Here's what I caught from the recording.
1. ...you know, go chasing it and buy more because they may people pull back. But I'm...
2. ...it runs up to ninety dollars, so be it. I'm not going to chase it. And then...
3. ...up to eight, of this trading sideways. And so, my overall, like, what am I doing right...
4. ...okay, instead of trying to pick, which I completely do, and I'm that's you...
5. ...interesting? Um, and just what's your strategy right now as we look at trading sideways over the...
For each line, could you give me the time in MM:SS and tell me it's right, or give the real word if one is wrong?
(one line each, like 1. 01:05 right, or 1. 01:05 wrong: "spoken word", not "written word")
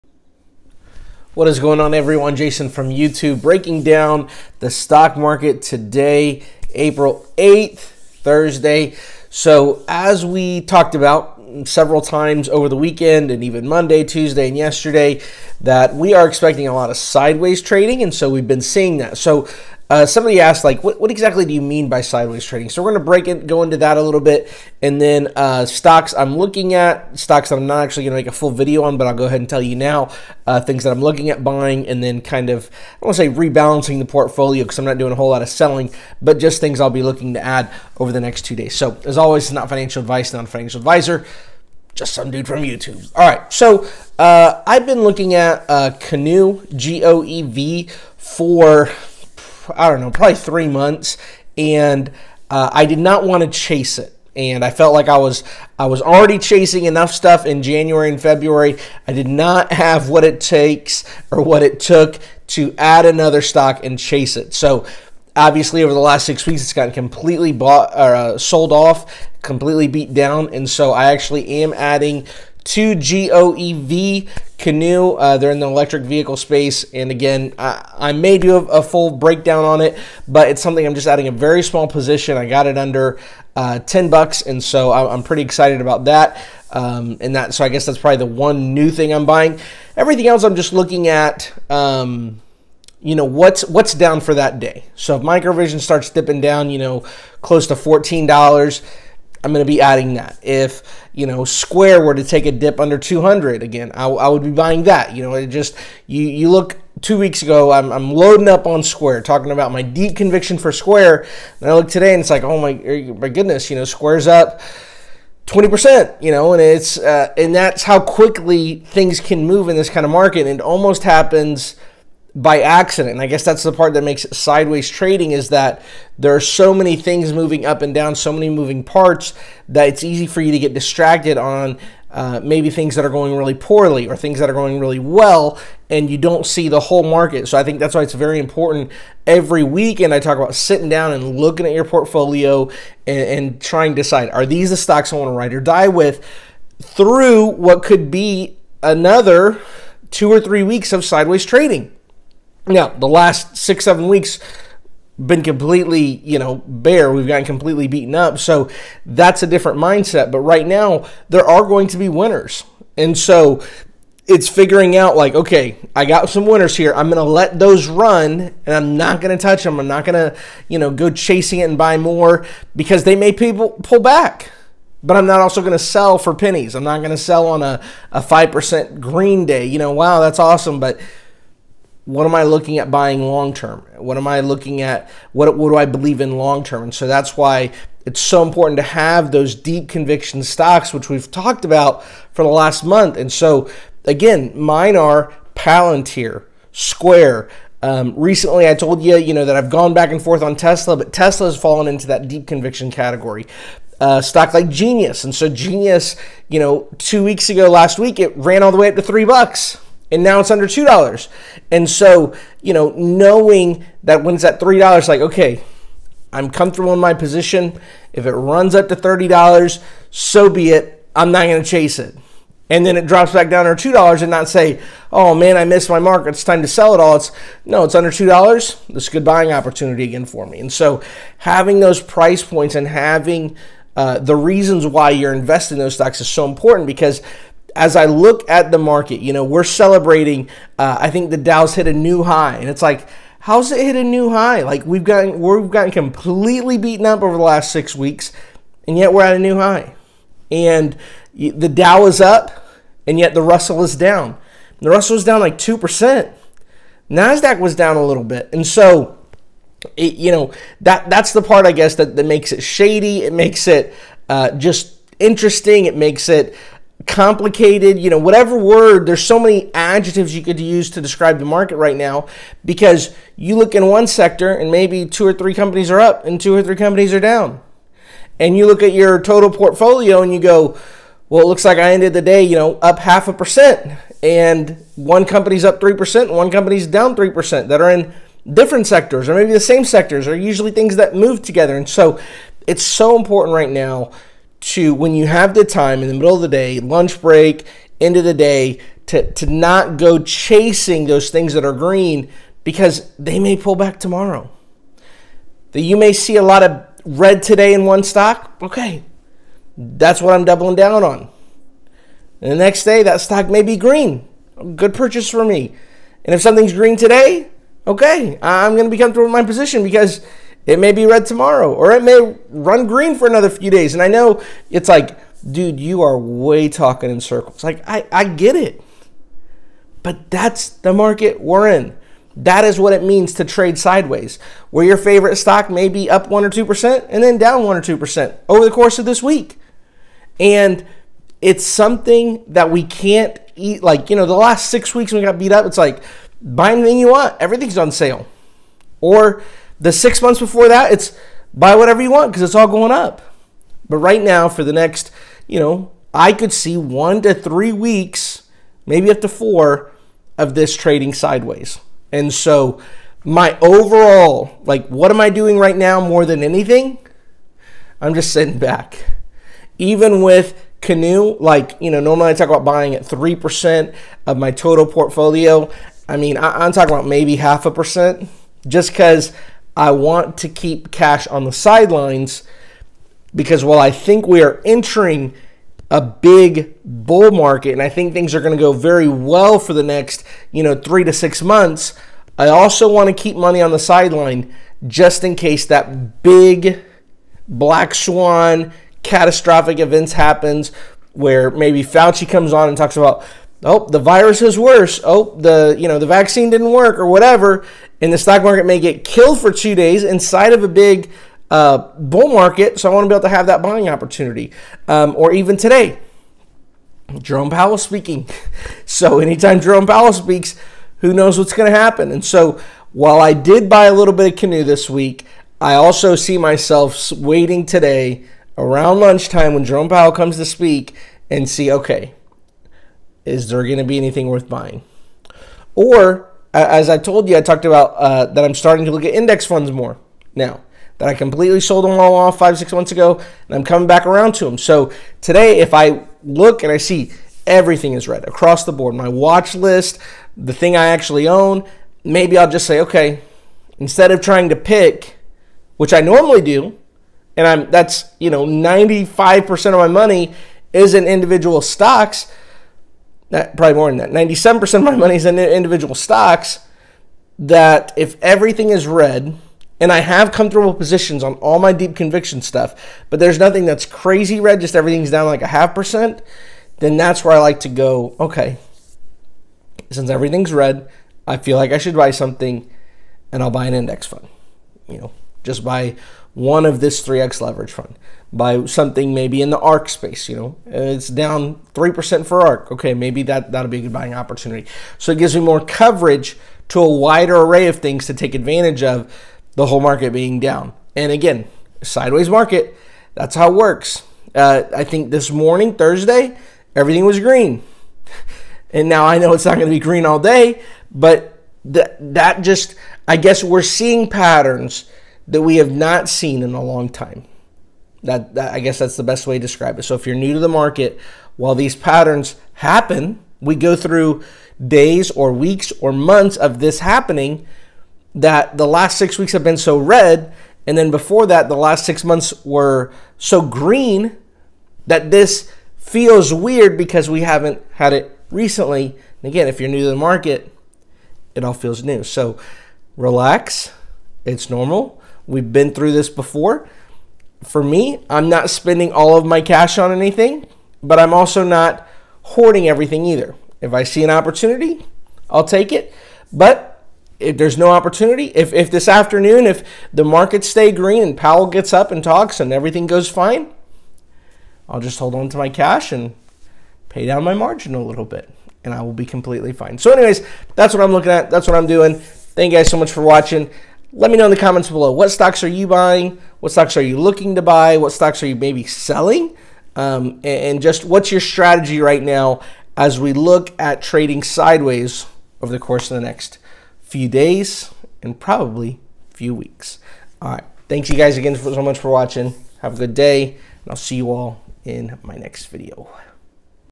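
1. 02:50 right
2. 03:38 wrong: "thirty", not "ninety"
3. 05:59 wrong: "four", not "eight"
4. 07:32 wrong: "normally", not "completely"
5. 09:38 wrong: "selling", not "interesting".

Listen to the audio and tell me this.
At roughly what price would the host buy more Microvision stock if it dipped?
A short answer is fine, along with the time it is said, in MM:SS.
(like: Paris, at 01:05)
$14, at 01:37.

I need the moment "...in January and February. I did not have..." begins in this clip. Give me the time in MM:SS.
00:57.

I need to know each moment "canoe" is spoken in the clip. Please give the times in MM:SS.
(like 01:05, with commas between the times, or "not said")
00:45, 01:14, 06:10, 07:04.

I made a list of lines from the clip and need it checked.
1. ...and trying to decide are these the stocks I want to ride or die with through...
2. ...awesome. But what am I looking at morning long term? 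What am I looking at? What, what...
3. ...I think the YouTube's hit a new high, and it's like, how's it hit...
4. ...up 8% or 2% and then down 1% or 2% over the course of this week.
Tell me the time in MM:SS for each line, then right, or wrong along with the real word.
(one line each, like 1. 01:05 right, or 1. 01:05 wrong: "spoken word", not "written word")
1. 02:23 right
2. 03:00 wrong: "buying", not "morning"
3. 04:00 wrong: "Dow", not "YouTube"
4. 05:36 wrong: "1", not "8".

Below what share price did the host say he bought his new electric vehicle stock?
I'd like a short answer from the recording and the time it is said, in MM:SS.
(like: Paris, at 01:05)
$10, at 01:23.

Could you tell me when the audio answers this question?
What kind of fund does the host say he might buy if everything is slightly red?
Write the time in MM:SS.
08:07.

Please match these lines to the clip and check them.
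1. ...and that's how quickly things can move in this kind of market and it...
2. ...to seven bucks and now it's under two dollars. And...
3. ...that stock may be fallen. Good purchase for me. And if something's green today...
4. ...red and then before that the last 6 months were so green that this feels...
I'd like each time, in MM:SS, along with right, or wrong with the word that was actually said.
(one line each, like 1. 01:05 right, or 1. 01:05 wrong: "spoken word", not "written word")
1. 01:57 right
2. 03:28 wrong: "three", not "seven"
3. 05:13 wrong: "green", not "fallen"
4. 08:49 right.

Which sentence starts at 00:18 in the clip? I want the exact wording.
And so, we've been seeing that.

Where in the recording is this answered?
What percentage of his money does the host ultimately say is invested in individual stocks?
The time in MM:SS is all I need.
07:44.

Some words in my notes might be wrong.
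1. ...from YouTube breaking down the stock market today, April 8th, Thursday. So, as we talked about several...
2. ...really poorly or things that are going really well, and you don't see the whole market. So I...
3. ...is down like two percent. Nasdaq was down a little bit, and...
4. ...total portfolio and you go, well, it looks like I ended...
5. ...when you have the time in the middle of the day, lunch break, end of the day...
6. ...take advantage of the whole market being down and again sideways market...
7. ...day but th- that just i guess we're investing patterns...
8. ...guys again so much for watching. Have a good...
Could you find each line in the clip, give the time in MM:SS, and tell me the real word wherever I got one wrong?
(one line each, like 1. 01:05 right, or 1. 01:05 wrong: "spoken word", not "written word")
1. 00:02 right
2. 02:13 right
3. 04:15 right
4. 04:39 right
5. 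04:54 right
6. 08:18 right
7. 08:30 wrong: "seeing", not "investing"
8. 09:50 right.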